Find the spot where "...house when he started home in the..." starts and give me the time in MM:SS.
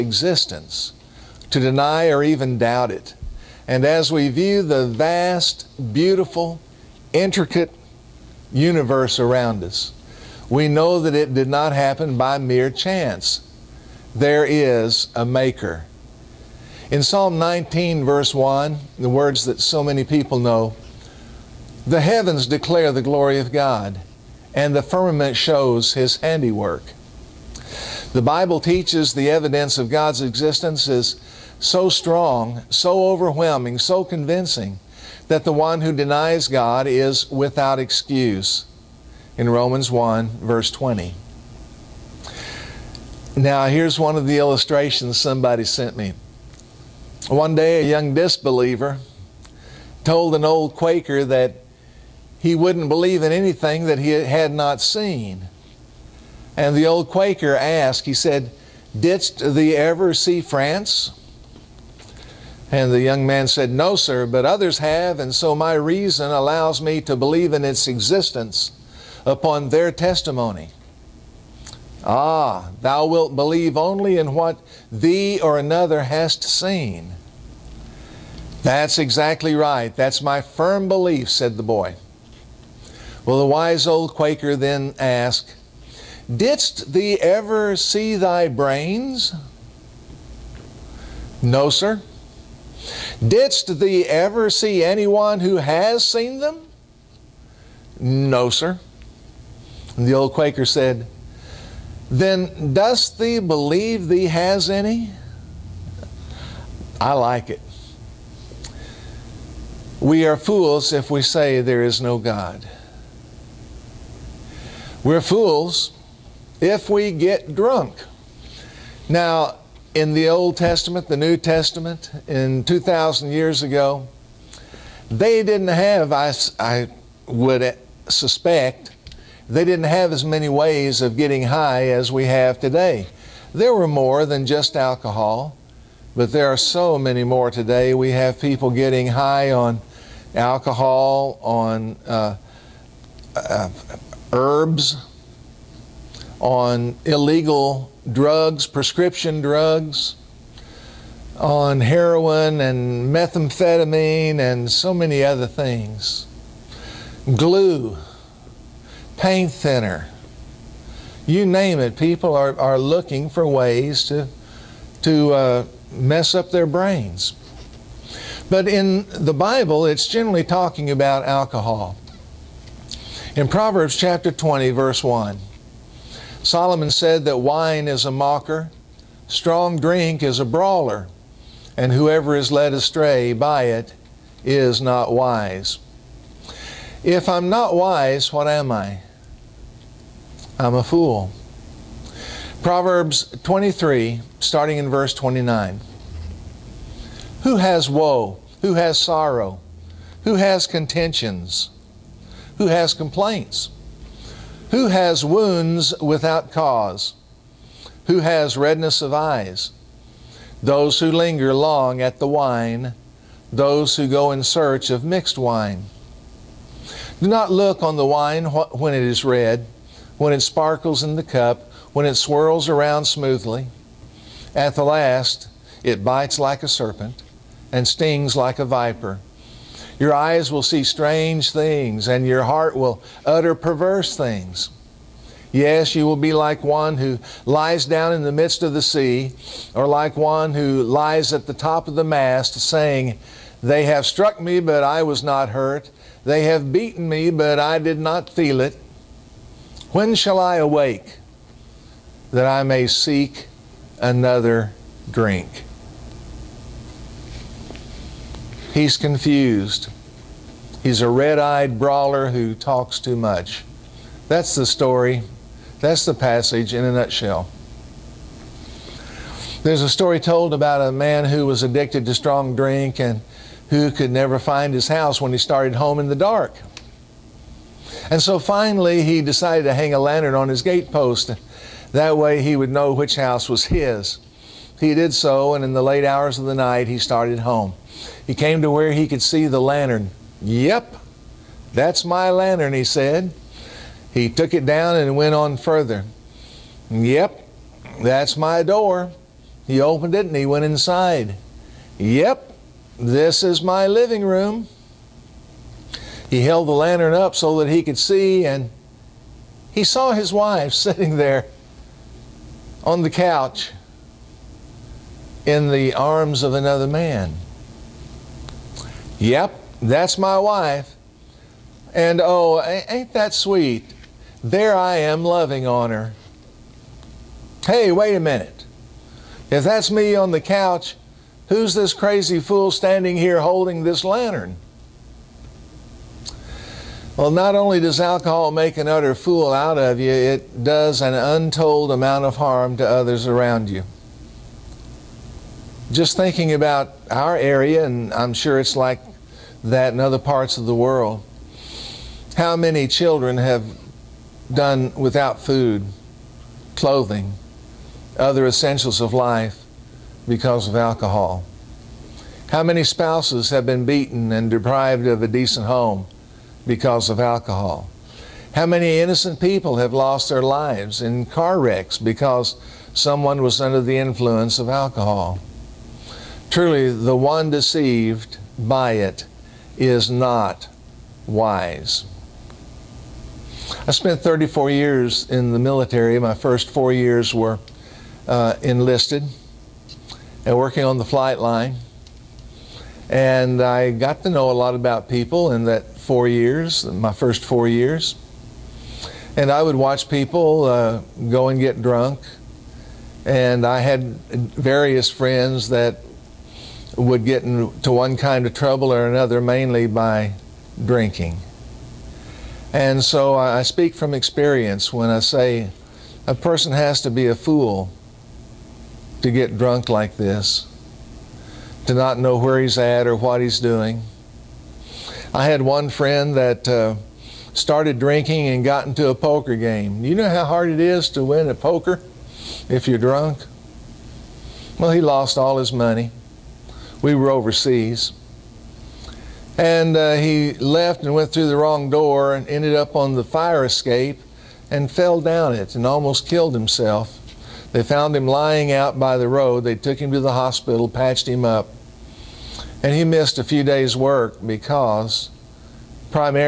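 04:34.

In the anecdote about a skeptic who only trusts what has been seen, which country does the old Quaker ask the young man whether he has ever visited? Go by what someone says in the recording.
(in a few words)
France.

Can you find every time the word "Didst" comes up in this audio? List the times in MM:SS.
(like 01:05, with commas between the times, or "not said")
00:58, 01:26, 01:33.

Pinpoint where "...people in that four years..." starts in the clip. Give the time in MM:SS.
06:35.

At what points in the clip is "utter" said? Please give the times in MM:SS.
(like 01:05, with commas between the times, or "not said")
03:53, 05:38.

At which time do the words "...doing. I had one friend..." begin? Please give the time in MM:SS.
07:03.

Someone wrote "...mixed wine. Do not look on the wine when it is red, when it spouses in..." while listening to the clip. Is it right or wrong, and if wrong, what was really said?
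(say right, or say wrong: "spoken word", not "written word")
wrong: "sparkles", not "spouses".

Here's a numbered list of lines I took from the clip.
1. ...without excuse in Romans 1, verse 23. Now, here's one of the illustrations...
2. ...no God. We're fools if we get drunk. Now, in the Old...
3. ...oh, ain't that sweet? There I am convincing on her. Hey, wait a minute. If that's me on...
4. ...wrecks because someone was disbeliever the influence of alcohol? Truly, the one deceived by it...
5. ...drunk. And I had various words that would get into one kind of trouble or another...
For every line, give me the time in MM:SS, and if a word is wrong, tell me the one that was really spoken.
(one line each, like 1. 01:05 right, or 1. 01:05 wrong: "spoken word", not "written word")
1. 00:37 wrong: "20", not "23"
2. 01:52 right
3. 05:22 wrong: "loving", not "convincing"
4. 06:11 wrong: "under", not "disbeliever"
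5. 06:41 wrong: "friends", not "words".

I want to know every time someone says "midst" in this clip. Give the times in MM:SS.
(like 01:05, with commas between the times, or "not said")
03:58.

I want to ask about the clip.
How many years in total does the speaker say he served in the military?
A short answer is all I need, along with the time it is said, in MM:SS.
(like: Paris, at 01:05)
34, at 06:24.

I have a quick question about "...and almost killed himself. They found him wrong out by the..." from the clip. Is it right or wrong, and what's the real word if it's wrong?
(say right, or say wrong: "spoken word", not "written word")
wrong: "lying", not "wrong".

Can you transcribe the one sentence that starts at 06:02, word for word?
How many spouses have been beaten and deprived of a decent home because of alcohol?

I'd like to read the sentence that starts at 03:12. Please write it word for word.
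Proverbs 23, starting in verse 29.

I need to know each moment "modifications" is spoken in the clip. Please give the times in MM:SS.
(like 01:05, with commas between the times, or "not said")
not said.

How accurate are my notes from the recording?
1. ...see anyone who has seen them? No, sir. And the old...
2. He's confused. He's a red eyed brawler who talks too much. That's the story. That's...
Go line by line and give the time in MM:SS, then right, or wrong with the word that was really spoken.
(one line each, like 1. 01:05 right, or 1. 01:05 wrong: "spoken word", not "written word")
1. 01:34 right
2. 04:18 right.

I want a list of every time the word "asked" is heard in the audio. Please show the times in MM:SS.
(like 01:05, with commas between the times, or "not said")
00:57, 01:24.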